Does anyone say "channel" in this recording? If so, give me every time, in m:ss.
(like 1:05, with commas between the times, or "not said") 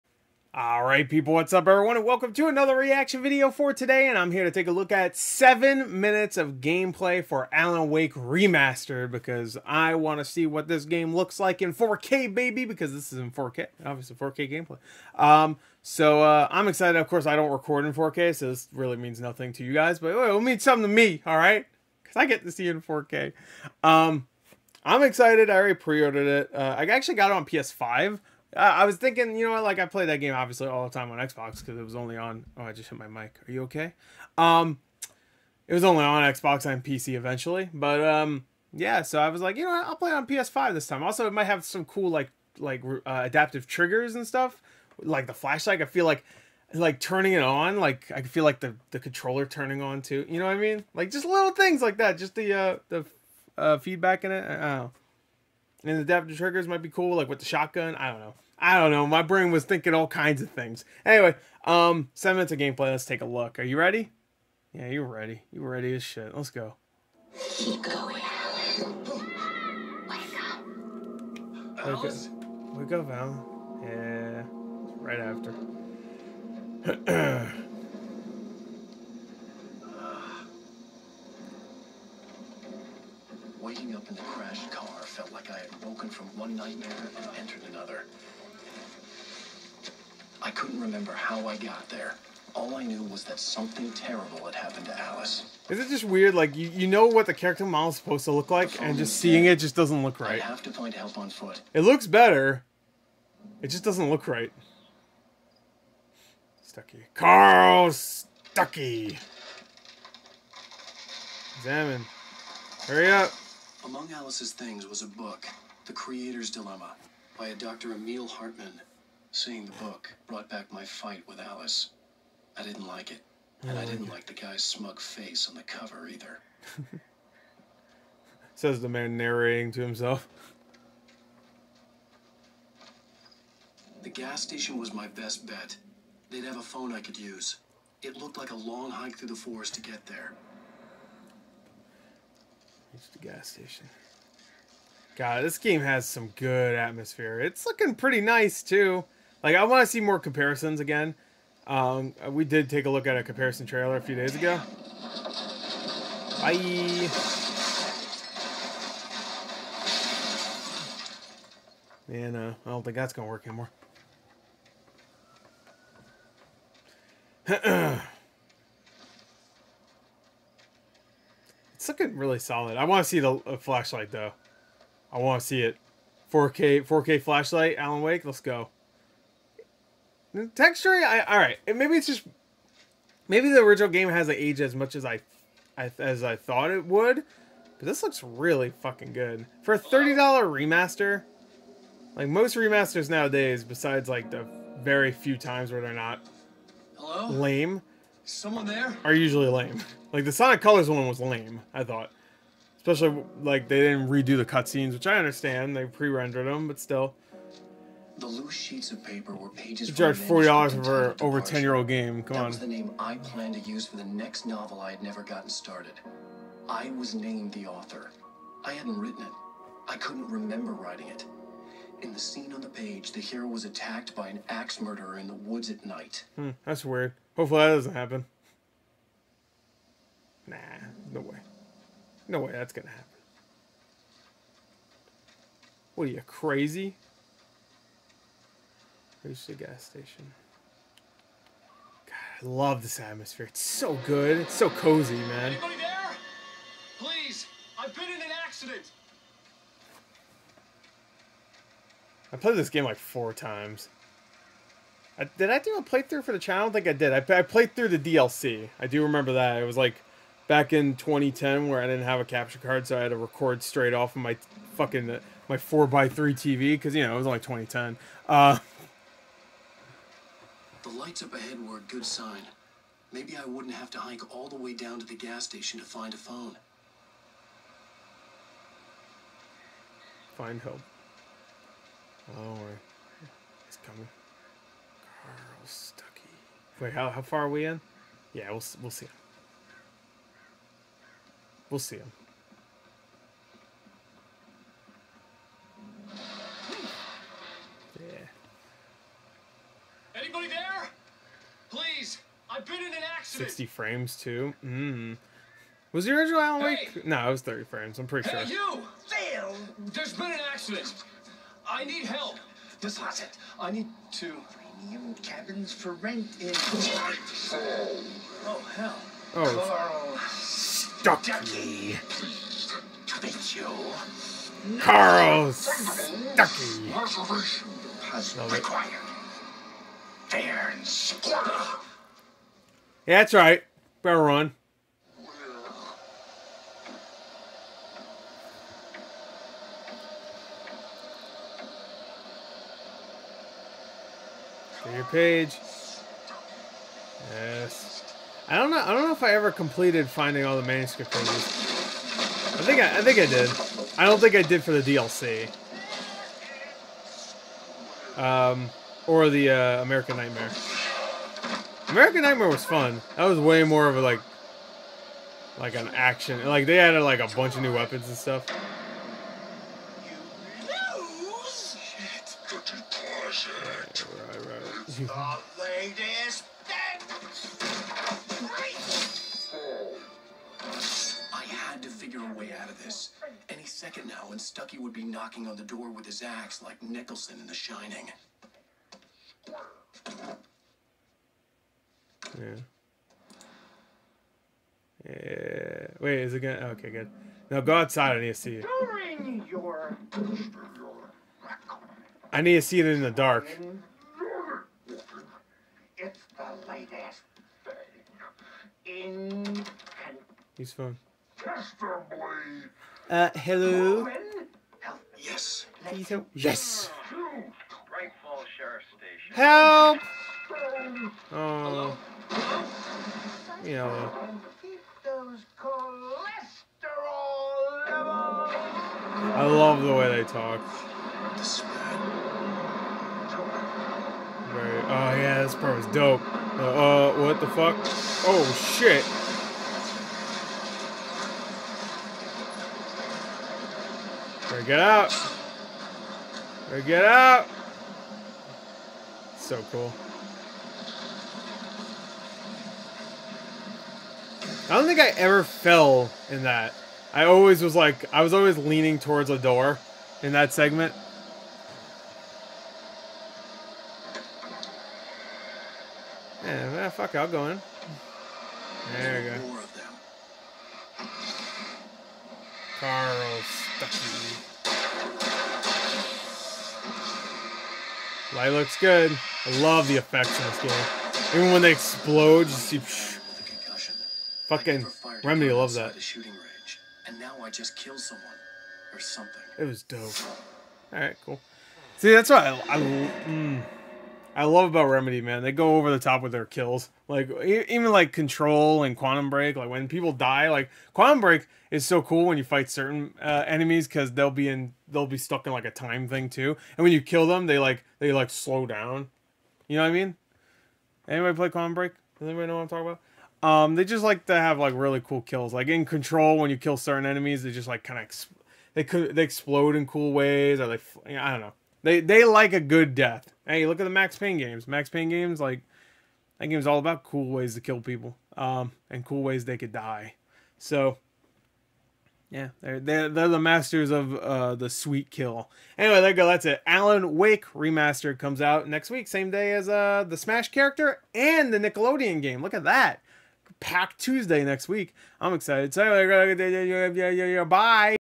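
4:16.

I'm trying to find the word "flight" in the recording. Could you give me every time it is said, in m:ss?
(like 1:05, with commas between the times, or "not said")
not said.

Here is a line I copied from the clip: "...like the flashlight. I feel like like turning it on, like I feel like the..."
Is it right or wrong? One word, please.
right.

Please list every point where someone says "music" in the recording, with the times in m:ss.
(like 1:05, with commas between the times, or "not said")
not said.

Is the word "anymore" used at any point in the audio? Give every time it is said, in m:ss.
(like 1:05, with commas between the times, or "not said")
2:43.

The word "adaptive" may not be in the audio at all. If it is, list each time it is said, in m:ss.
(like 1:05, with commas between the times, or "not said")
0:43, 0:56.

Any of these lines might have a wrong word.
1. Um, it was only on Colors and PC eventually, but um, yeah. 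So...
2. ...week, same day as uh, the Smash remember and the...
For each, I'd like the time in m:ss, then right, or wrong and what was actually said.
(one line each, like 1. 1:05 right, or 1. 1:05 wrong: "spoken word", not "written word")
1. 0:34 wrong: "Xbox", not "Colors"
2. 8:58 wrong: "character", not "remember".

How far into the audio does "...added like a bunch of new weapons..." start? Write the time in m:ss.
6:06.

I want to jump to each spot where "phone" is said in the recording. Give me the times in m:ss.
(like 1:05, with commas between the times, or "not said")
2:16, 4:36.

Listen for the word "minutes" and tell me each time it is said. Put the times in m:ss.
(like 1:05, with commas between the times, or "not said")
0:06, 1:02.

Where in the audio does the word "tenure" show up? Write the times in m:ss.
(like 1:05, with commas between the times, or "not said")
not said.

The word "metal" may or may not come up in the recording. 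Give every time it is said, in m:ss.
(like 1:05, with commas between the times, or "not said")
not said.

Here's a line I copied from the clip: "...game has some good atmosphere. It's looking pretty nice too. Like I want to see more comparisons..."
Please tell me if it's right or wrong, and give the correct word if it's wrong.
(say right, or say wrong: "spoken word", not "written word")
right.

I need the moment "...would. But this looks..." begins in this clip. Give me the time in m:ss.
3:06.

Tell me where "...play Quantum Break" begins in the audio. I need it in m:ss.
8:31.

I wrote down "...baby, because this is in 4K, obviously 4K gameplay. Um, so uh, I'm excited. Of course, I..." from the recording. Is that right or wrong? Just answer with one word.
right.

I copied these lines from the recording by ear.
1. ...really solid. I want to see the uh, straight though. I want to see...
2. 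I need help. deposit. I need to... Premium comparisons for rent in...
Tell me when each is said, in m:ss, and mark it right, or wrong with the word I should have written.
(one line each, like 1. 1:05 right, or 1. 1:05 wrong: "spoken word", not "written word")
1. 2:52 wrong: "flashlight", not "straight"
2. 5:11 wrong: "cabins", not "comparisons".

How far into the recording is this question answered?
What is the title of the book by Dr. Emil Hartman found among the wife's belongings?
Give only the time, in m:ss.
1:55.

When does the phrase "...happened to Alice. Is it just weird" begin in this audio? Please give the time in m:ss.
1:34.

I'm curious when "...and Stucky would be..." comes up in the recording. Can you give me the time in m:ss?
6:24.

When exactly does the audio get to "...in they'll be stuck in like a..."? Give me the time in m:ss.
8:24.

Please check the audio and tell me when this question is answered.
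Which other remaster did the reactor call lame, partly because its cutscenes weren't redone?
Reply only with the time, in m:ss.
3:20.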